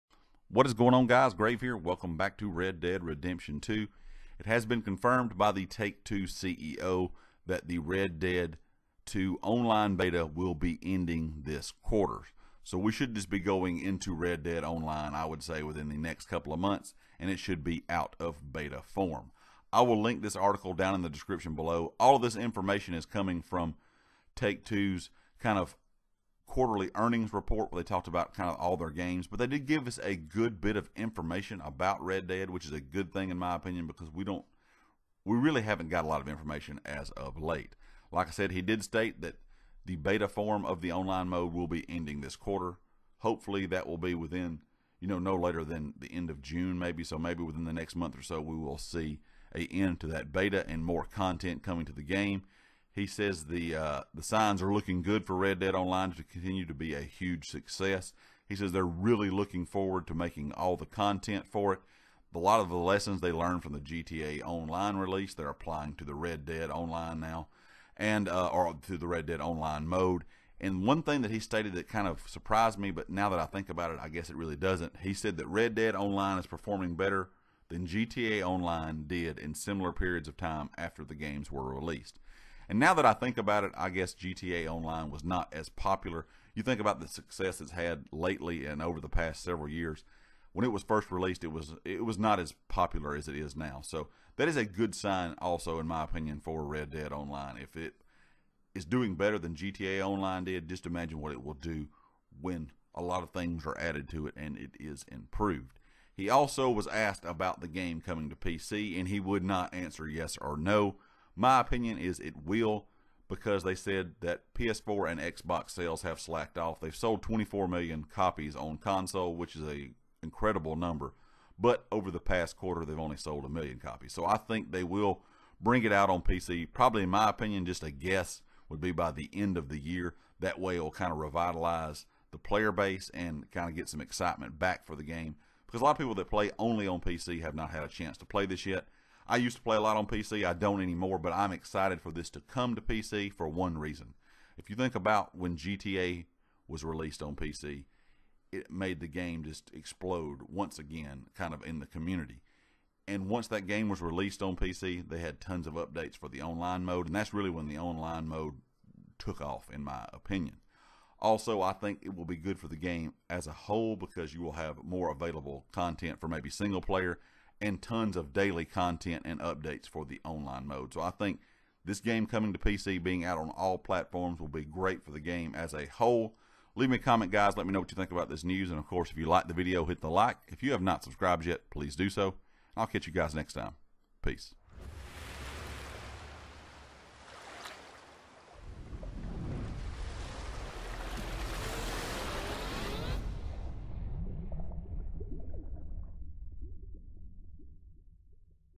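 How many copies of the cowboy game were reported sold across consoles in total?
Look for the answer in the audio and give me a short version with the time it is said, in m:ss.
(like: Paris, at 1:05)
24 million, at 1:57.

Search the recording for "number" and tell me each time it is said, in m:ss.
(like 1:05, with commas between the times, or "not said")
2:00.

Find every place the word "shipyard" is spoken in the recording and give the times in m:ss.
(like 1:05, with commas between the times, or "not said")
not said.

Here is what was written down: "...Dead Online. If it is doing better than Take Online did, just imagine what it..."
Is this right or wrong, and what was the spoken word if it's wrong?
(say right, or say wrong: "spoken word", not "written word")
wrong: "GTA", not "Take".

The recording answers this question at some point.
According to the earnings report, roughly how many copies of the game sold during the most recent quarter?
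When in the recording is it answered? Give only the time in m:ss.
2:03.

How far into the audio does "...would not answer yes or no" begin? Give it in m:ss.
1:49.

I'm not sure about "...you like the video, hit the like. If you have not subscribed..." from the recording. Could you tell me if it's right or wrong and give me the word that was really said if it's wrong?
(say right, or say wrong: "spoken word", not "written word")
right.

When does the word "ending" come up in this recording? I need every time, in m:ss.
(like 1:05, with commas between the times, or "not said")
0:10, 0:41.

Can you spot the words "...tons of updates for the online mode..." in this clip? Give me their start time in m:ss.
2:35.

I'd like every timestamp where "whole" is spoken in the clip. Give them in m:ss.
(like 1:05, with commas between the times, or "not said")
2:43, 2:55.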